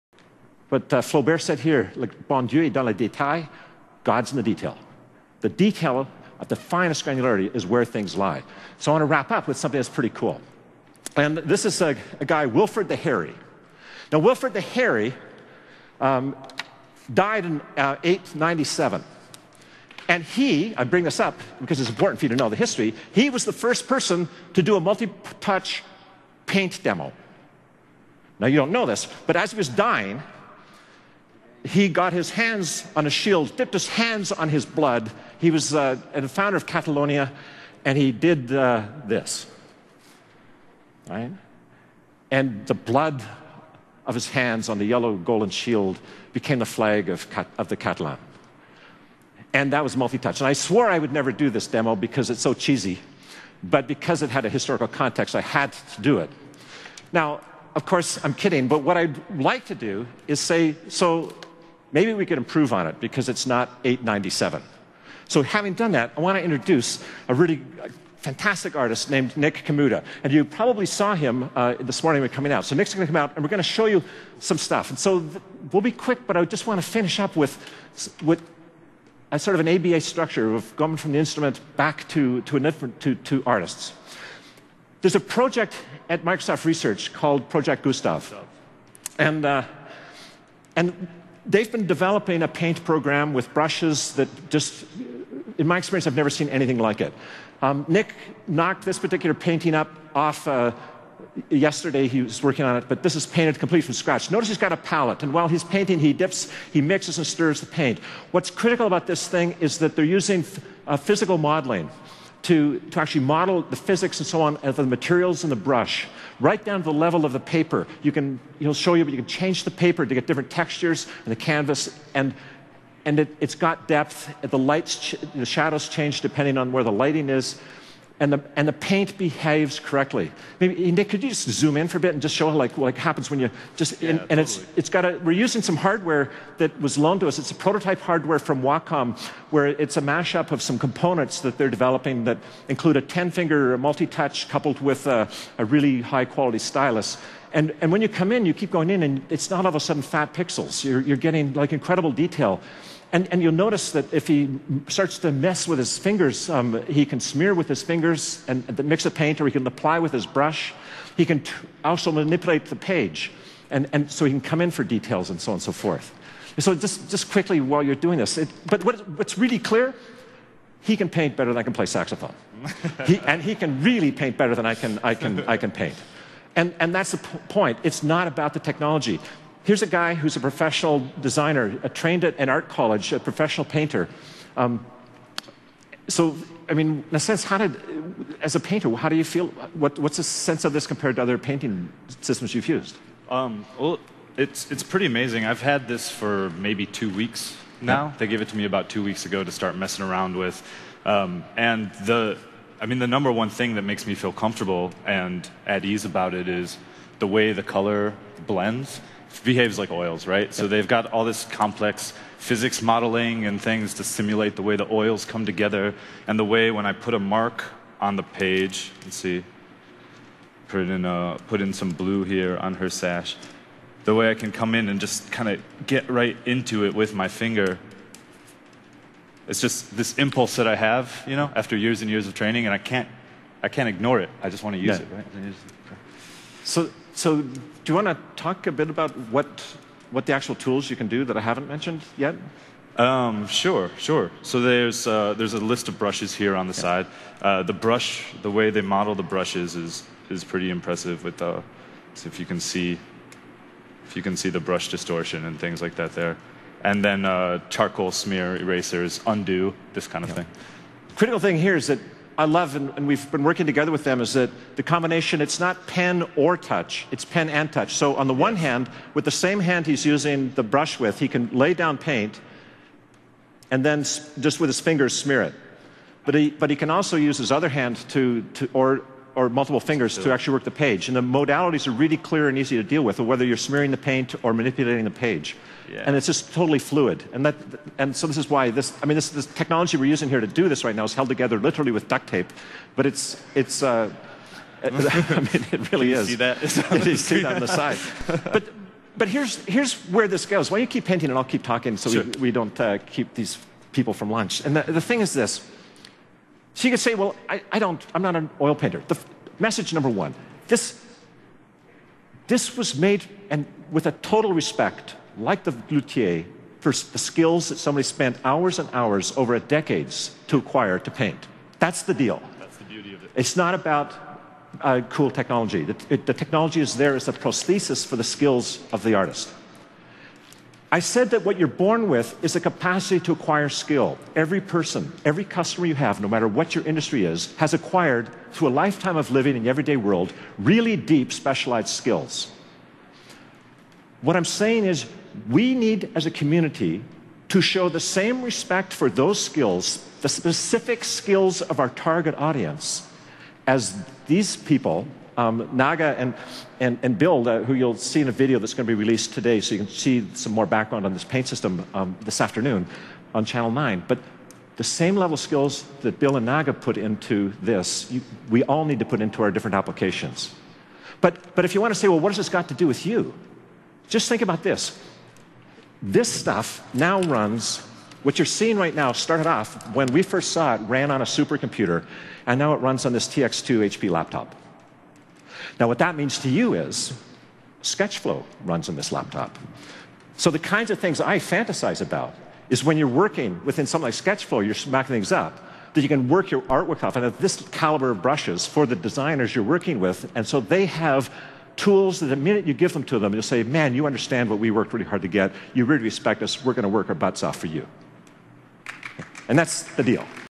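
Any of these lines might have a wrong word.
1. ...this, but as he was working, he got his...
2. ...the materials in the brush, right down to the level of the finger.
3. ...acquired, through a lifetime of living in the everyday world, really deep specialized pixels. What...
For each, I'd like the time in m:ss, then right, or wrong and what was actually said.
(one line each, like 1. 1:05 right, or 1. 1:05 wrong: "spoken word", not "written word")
1. 0:28 wrong: "dying", not "working"
2. 1:54 wrong: "paper", not "finger"
3. 5:37 wrong: "skills", not "pixels".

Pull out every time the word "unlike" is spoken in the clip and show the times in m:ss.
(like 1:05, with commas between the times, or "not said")
not said.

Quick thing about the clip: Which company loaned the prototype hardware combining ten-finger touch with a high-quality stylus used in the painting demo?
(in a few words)
Wacom.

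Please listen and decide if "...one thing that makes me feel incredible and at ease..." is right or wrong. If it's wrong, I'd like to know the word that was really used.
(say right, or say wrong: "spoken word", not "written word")
wrong: "comfortable", not "incredible".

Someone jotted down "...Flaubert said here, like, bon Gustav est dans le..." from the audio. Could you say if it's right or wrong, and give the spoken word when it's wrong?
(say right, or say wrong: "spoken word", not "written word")
wrong: "Dieu", not "Gustav".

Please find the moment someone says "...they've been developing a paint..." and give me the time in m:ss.
1:31.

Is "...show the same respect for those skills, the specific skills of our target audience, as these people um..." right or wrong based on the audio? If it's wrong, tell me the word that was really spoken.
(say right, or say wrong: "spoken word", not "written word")
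right.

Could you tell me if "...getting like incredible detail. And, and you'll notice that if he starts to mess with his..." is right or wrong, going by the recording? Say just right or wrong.
right.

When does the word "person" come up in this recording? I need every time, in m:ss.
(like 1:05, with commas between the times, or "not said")
0:23, 5:34.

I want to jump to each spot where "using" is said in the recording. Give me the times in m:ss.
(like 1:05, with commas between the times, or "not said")
1:50, 2:15, 4:30, 4:50.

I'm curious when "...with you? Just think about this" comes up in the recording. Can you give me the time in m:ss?
6:12.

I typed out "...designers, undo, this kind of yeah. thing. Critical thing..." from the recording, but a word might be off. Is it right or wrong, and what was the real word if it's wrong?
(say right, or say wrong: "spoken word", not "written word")
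wrong: "erasers", not "designers".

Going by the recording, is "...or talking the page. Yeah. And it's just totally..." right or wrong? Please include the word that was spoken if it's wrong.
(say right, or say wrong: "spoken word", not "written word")
wrong: "manipulating", not "talking".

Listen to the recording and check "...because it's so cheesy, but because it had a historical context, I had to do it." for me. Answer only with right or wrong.
right.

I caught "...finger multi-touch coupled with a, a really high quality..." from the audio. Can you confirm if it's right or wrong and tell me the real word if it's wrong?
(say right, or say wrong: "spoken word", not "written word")
right.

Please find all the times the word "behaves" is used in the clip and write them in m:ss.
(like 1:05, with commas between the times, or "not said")
2:09, 3:29.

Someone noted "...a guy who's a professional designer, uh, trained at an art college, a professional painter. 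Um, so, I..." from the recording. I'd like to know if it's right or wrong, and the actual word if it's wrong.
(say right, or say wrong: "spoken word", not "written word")
right.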